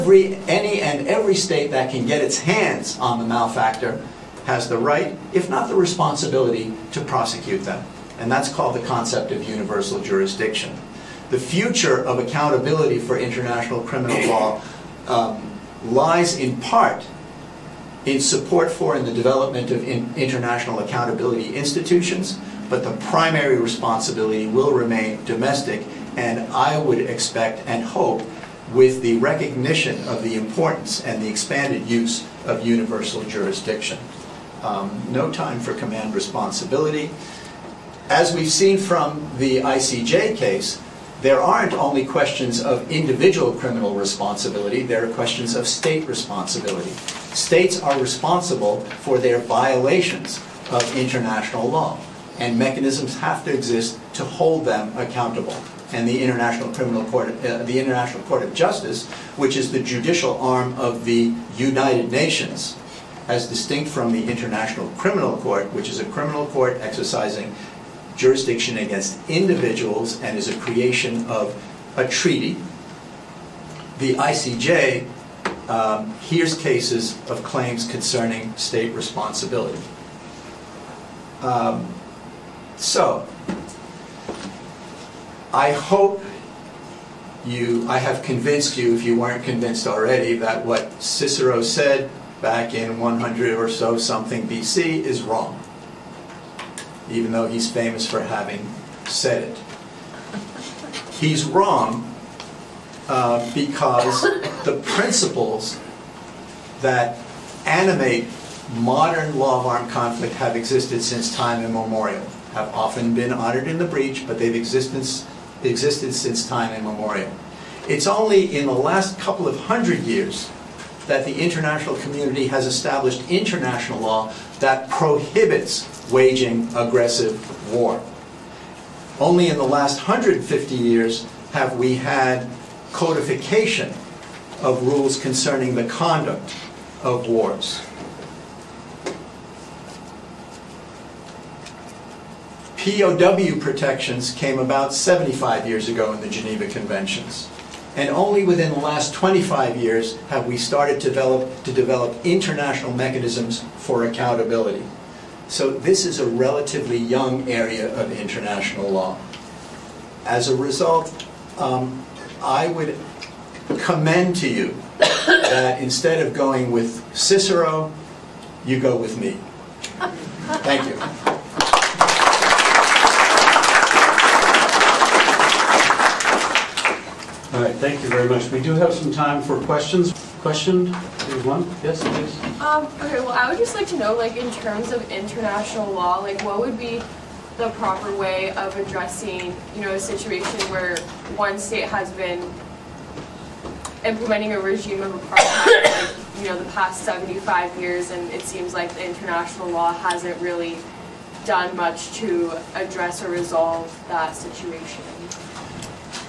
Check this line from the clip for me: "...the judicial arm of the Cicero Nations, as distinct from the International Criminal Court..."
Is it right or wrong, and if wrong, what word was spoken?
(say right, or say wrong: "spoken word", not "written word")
wrong: "United", not "Cicero".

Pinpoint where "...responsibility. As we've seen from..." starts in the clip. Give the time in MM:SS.
00:36.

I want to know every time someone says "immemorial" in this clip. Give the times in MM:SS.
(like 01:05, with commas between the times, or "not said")
01:51, 01:56.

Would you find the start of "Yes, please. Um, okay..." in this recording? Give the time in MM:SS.
03:01.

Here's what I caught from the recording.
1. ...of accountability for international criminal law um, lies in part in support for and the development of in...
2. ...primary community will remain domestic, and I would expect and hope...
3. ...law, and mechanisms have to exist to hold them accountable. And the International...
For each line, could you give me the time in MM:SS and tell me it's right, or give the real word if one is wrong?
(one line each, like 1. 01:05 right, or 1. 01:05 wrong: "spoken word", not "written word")
1. 00:12 right
2. 00:23 wrong: "responsibility", not "community"
3. 00:51 right.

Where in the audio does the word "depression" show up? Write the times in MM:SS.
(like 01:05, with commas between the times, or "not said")
not said.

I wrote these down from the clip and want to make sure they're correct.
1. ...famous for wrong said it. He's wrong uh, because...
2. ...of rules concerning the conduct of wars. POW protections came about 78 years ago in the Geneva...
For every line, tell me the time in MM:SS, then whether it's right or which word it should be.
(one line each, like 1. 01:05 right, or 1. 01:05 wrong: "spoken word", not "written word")
1. 01:37 wrong: "having", not "wrong"
2. 02:14 wrong: "75", not "78".